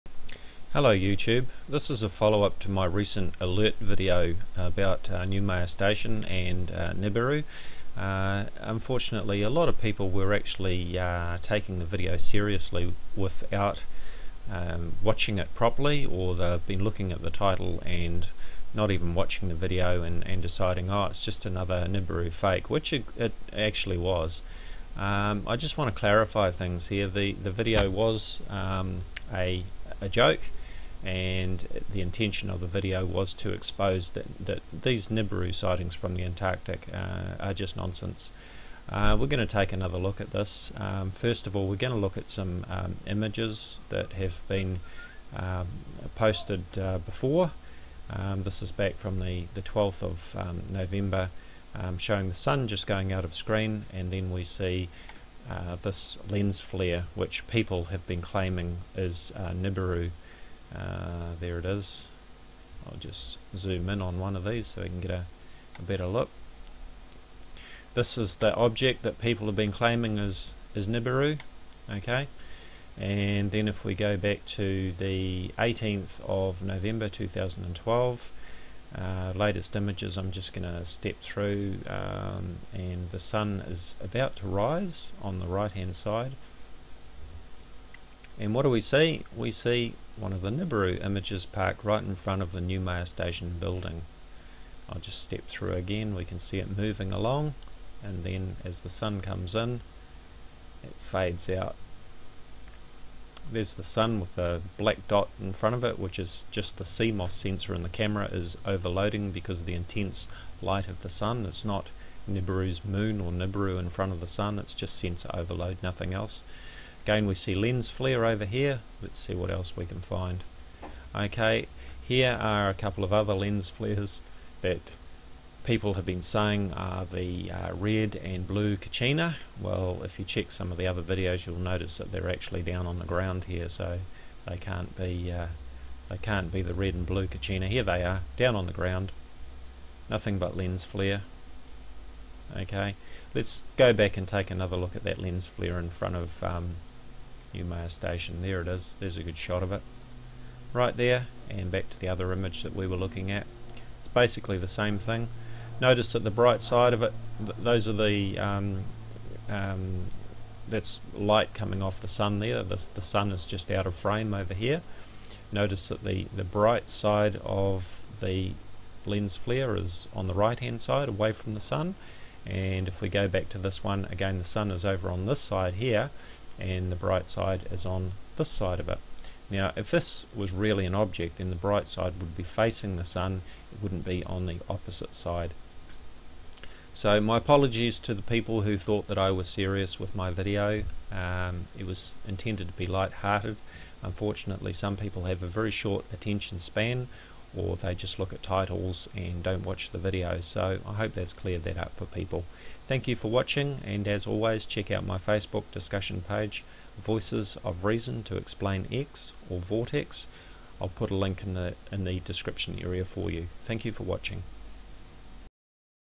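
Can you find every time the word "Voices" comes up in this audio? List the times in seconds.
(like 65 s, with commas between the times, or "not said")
206 s.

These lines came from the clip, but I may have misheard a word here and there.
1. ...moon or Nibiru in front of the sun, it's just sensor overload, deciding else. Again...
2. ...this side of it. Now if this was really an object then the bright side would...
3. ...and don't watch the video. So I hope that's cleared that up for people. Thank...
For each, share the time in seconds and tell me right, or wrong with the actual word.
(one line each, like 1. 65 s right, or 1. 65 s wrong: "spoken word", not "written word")
1. 112 s wrong: "nothing", not "deciding"
2. 178 s right
3. 199 s right.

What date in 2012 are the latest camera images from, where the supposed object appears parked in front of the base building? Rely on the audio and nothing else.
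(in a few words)
18th of November 2012.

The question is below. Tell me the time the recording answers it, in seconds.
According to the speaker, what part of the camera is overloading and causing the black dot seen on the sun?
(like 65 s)
106 s.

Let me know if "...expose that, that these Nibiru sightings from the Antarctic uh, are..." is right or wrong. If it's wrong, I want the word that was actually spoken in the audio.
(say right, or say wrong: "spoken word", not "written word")
right.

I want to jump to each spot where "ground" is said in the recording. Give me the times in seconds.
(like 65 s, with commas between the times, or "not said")
133 s, 138 s.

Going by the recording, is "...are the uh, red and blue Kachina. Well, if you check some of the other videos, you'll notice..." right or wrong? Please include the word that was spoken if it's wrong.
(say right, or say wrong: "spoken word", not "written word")
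right.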